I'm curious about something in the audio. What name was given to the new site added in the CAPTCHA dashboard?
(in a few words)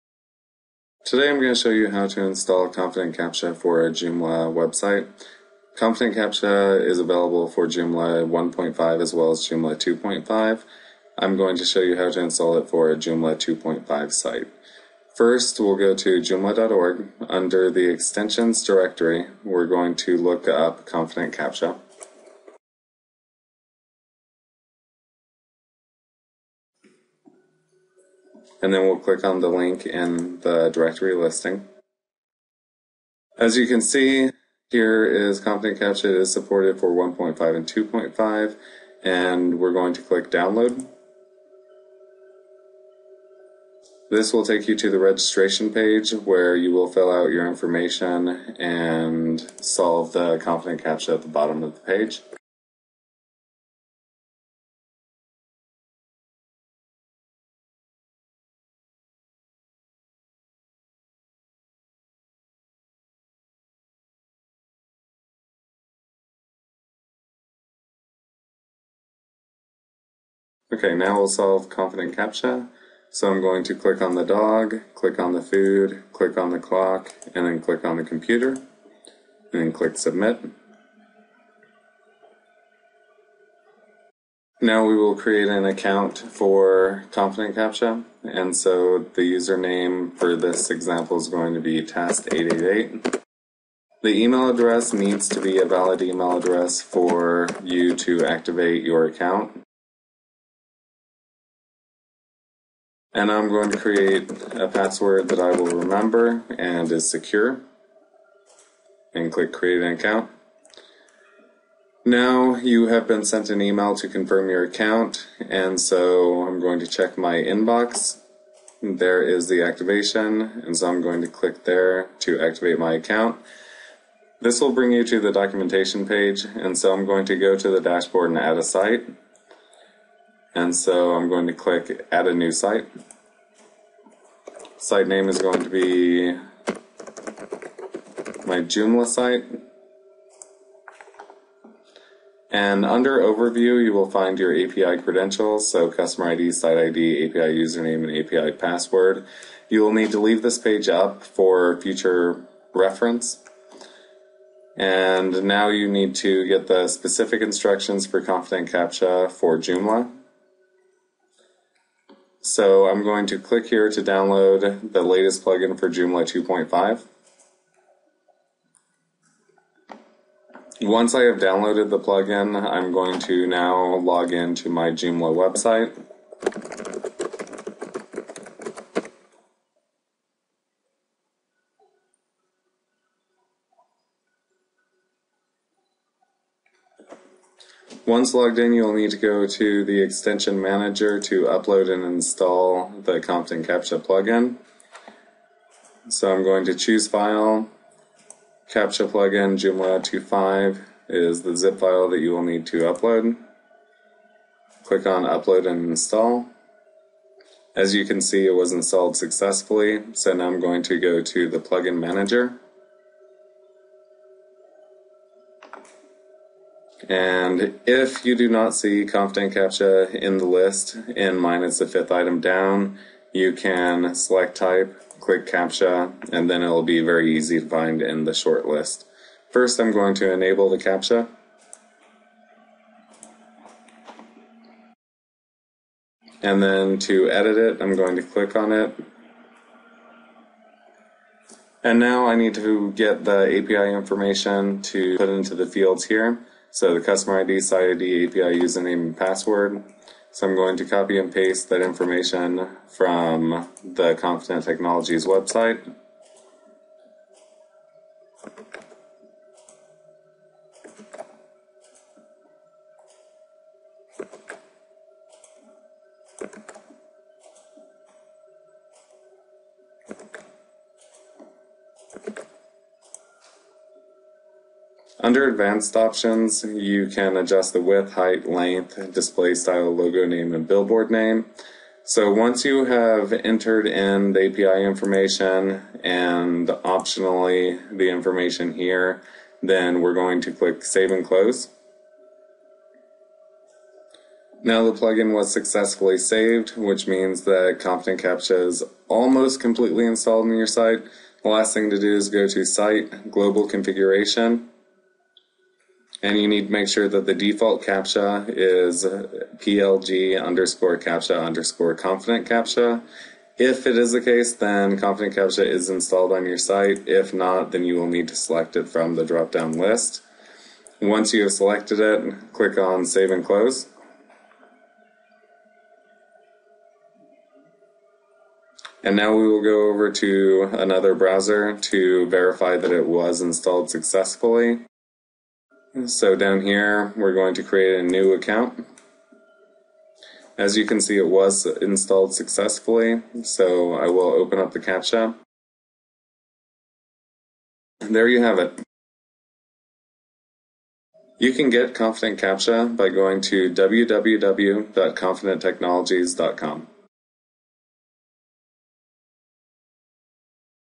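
my Joomla site.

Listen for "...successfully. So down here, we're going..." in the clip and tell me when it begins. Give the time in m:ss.
5:33.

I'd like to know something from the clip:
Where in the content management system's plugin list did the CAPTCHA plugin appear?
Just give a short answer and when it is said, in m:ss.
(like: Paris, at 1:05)
fifth item down, at 3:41.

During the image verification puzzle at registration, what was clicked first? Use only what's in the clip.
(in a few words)
the dog.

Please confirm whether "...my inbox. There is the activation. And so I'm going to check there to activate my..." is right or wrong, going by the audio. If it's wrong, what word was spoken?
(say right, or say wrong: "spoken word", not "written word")
wrong: "click", not "check".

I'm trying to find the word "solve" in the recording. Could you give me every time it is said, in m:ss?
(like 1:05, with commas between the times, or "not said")
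0:49, 1:11.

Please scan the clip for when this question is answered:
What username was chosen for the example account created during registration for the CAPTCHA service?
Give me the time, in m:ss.
1:31.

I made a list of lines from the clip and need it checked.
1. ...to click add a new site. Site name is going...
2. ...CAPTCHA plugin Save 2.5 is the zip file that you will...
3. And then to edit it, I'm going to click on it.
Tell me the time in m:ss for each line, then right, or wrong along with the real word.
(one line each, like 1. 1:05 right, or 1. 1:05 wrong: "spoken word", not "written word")
1. 2:11 right
2. 3:18 wrong: "Joomla", not "Save"
3. 3:56 right.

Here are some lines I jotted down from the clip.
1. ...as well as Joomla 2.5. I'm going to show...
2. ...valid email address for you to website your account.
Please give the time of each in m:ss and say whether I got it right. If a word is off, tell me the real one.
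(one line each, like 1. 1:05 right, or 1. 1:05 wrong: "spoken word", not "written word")
1. 0:09 right
2. 1:35 wrong: "activate", not "website".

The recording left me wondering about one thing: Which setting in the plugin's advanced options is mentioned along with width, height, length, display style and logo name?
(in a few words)
billboard name.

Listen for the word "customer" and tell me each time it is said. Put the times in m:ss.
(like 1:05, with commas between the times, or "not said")
2:25, 4:07.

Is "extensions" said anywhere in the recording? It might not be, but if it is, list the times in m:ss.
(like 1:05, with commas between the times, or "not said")
0:17, 3:10.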